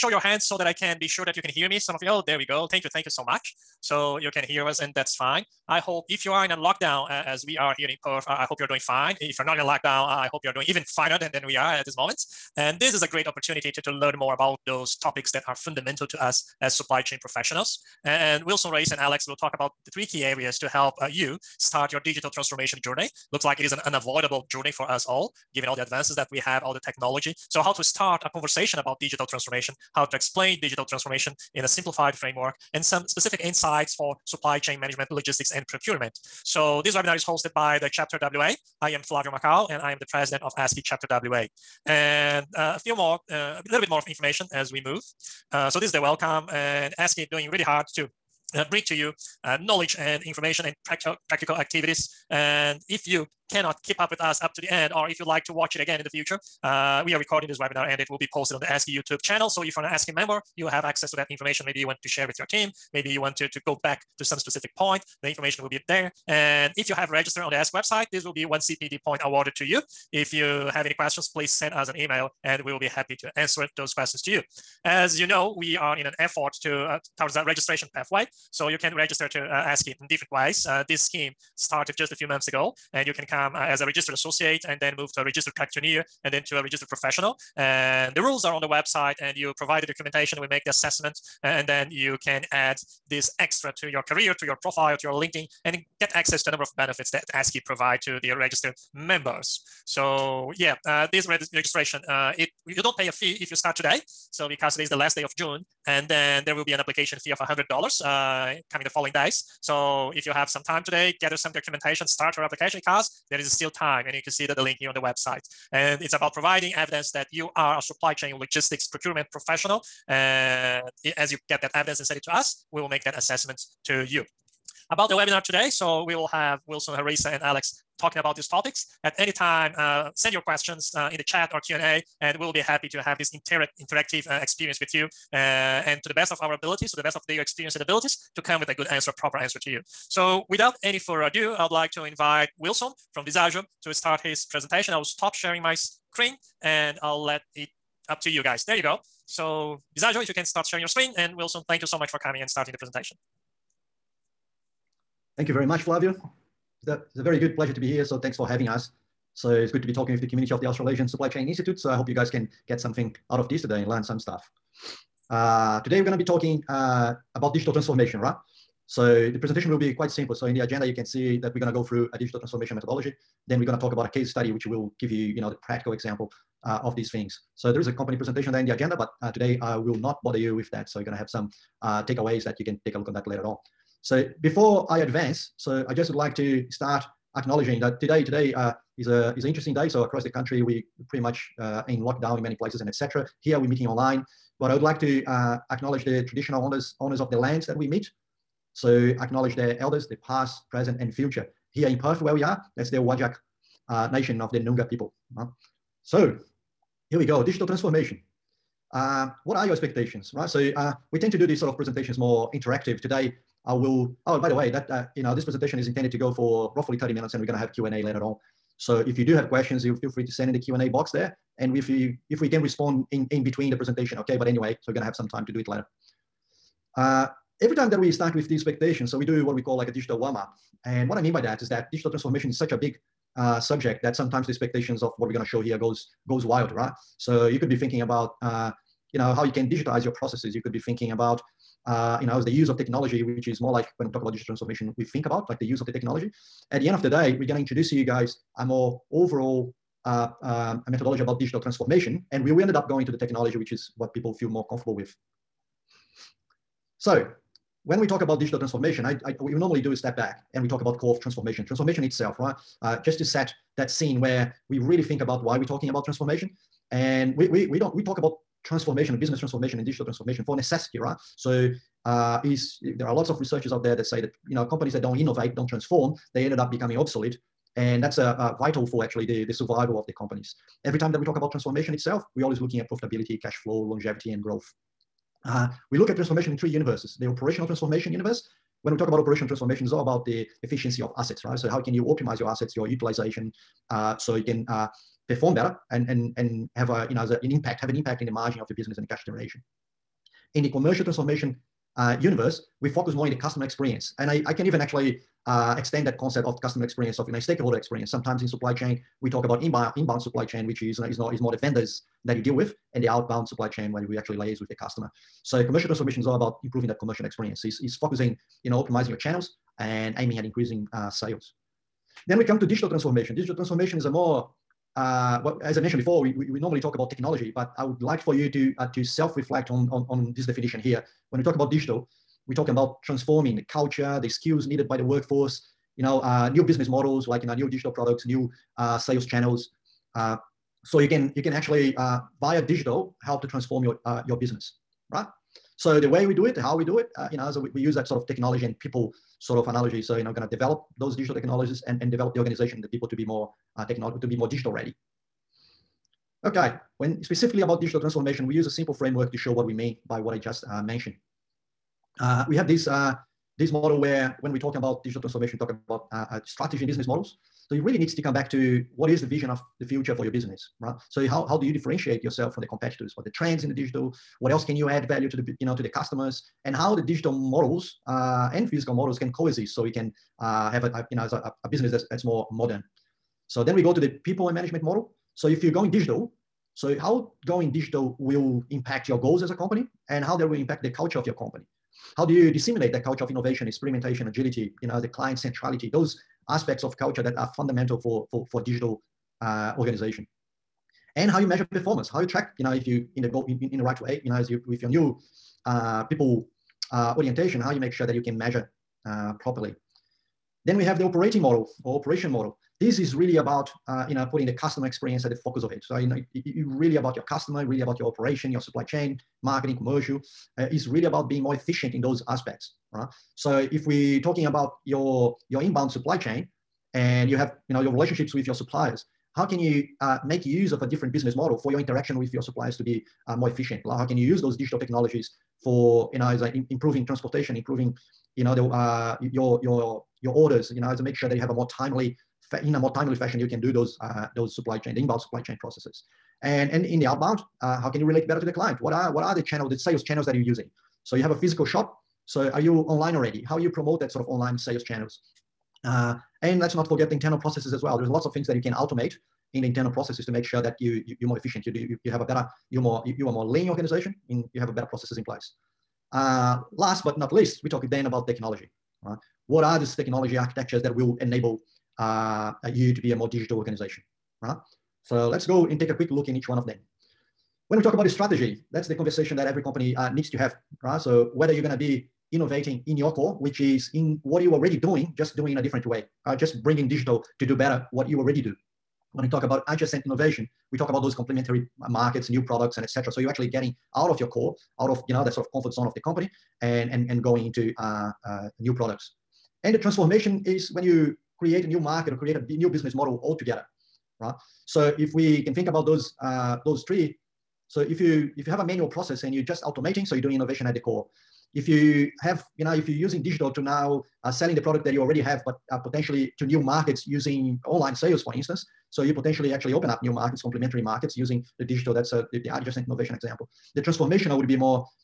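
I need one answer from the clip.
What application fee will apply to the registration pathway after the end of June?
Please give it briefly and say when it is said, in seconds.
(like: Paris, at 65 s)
$100, at 107 s.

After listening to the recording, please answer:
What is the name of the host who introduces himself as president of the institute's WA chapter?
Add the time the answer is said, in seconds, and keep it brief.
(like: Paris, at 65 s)
Flavio Macau, at 39 s.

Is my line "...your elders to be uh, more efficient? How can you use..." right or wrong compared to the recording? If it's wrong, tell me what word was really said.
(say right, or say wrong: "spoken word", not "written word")
wrong: "suppliers", not "elders".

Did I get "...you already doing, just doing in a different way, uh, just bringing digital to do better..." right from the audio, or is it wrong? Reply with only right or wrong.
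right.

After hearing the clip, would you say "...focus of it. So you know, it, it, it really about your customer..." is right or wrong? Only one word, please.
right.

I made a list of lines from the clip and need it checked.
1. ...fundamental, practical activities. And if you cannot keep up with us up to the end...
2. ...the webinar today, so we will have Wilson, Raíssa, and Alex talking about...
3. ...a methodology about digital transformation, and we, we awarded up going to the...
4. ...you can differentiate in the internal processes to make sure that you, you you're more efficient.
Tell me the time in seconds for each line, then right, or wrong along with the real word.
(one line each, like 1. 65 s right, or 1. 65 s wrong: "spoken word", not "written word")
1. 50 s wrong: "practical", not "fundamental"
2. 125 s right
3. 250 s wrong: "ended", not "awarded"
4. 458 s wrong: "automate", not "differentiate".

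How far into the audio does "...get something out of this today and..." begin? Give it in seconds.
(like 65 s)
162 s.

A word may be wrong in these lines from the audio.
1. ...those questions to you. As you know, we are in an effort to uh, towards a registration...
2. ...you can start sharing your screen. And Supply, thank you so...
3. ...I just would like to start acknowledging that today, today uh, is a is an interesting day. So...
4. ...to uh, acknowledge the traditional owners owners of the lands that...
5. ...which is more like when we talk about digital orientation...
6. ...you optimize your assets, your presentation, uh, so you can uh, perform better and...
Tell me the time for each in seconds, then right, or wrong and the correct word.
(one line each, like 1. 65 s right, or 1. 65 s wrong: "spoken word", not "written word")
1. 73 s right
2. 150 s wrong: "Wilson", not "Supply"
3. 185 s right
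4. 194 s right
5. 243 s wrong: "transformation", not "orientation"
6. 291 s wrong: "utilization", not "presentation".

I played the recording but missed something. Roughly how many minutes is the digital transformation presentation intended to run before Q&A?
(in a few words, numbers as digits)
30 minutes.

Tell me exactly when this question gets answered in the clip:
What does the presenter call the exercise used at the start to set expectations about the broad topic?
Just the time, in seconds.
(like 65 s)
229 s.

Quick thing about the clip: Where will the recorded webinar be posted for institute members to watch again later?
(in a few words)
ASCI YouTube channel.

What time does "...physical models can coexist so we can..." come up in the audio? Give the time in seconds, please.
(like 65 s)
378 s.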